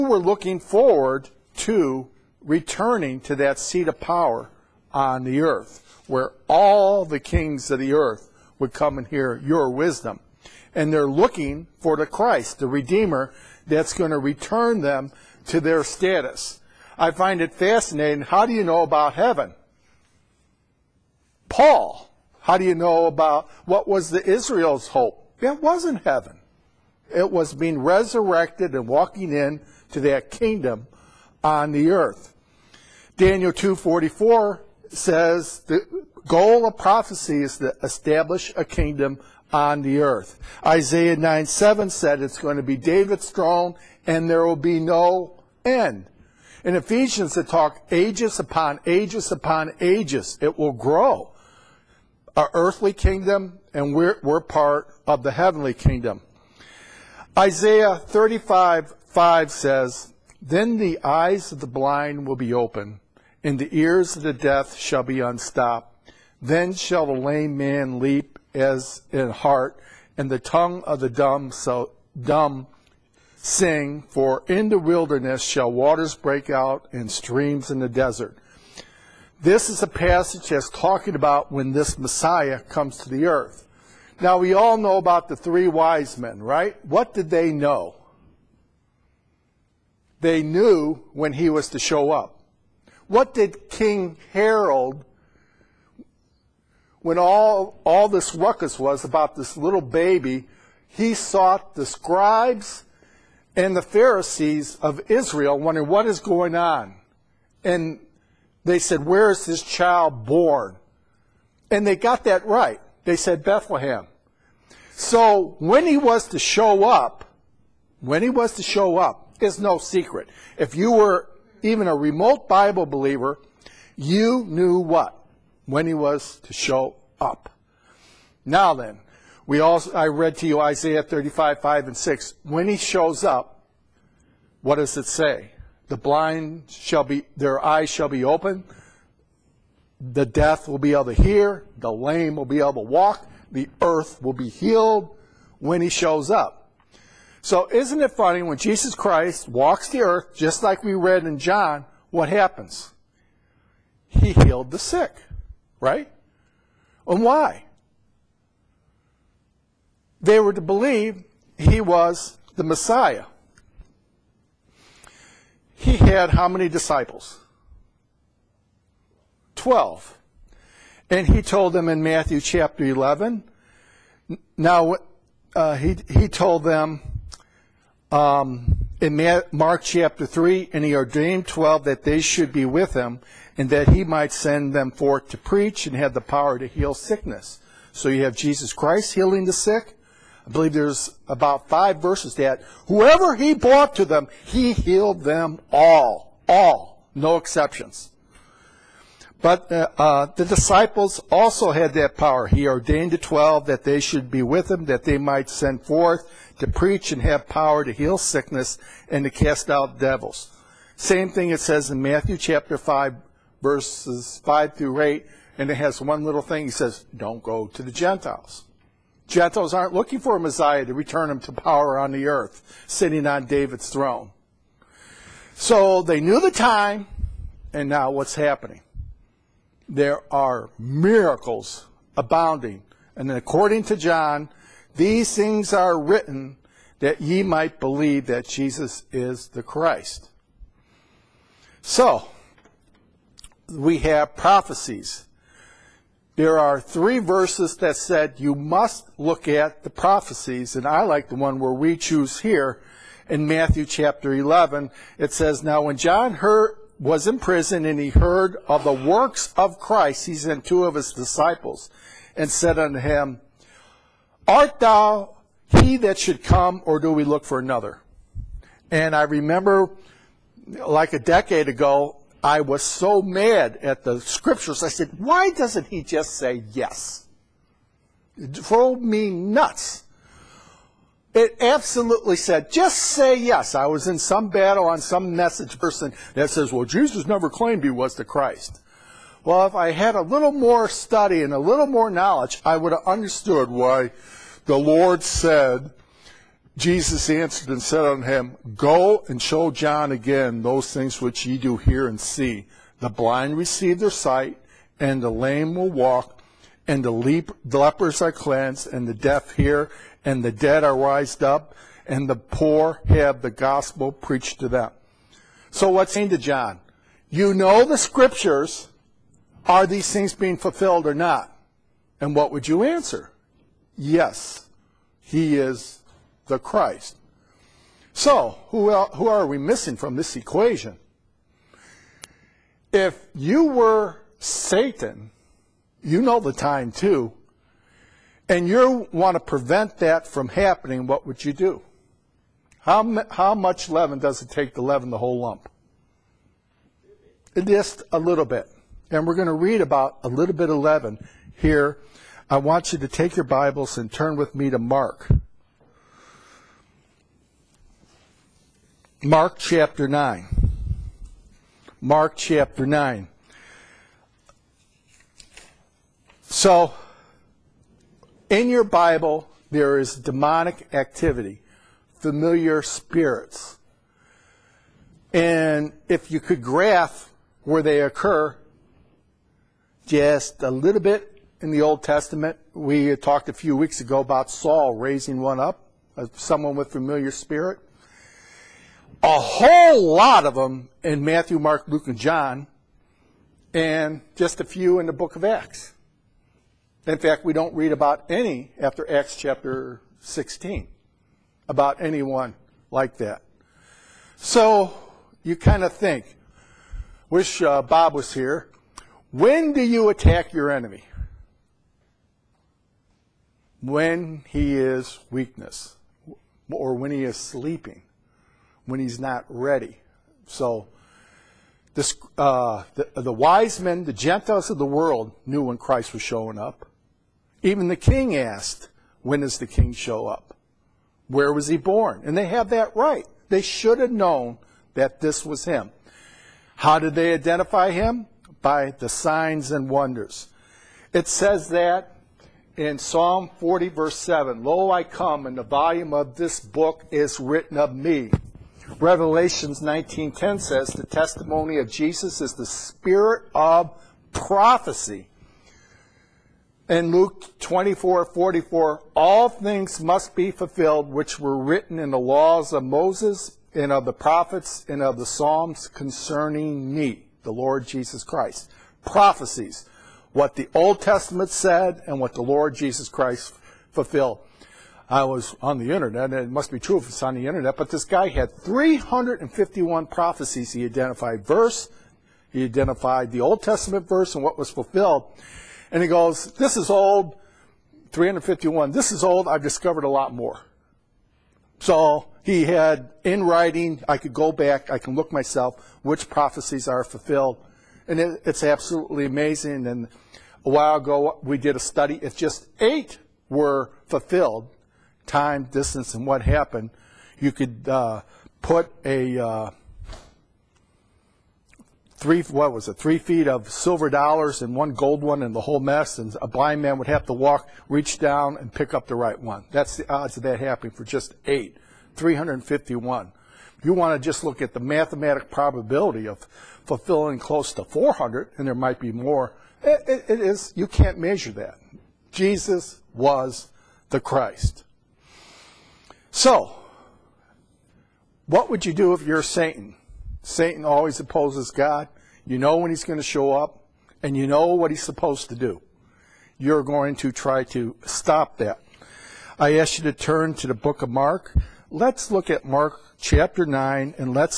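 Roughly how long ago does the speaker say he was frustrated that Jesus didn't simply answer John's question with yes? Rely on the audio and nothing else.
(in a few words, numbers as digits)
a decade ago.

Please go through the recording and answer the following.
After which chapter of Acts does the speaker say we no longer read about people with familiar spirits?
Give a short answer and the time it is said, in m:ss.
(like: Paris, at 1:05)
Acts chapter 16, at 6:39.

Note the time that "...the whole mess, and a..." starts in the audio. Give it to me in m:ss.
8:35.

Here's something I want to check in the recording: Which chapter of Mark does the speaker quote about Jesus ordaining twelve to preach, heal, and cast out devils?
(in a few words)
Mark chapter 3.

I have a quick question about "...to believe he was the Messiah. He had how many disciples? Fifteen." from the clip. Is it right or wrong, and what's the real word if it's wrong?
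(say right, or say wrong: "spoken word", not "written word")
wrong: "Twelve", not "Fifteen".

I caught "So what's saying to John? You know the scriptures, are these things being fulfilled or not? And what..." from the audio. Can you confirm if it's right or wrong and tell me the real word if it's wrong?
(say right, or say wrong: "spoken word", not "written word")
right.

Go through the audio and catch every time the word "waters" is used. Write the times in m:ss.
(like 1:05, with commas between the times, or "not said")
1:15.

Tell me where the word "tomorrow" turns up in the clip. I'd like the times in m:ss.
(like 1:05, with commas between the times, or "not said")
not said.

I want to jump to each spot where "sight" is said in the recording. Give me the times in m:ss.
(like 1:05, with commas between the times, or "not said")
5:04.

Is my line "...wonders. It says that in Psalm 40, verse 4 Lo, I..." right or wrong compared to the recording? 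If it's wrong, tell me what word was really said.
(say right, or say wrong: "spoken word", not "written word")
wrong: "7", not "4".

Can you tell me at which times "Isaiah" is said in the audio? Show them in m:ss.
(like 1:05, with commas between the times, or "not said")
0:40, 0:57, 2:10.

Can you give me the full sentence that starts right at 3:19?
But uh, uh, the disciples also had that power.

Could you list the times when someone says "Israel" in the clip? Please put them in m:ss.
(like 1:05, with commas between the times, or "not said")
0:24, 1:45.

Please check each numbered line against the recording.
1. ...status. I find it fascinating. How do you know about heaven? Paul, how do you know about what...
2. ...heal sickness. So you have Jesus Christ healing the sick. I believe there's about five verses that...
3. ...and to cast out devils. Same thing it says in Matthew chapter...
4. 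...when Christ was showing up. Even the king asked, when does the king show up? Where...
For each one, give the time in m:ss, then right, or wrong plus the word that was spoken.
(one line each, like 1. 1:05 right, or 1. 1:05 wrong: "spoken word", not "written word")
1. 0:15 right
2. 3:06 right
3. 3:29 right
4. 7:05 right.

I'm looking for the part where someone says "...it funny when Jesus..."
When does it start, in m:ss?
2:28.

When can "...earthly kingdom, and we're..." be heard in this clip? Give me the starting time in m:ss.
0:52.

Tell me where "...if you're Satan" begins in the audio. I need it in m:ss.
8:59.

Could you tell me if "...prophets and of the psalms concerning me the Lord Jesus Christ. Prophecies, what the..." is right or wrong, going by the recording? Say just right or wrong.
right.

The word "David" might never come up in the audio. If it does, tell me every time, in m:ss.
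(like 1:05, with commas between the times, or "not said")
0:42, 3:43.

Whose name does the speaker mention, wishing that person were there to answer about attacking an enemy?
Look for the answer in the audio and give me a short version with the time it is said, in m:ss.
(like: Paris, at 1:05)
Bob, at 6:47.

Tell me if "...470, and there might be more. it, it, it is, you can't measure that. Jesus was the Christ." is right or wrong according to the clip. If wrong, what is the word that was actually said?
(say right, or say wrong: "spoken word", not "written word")
wrong: "400", not "470".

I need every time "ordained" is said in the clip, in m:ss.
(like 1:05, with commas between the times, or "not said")
3:00, 3:22.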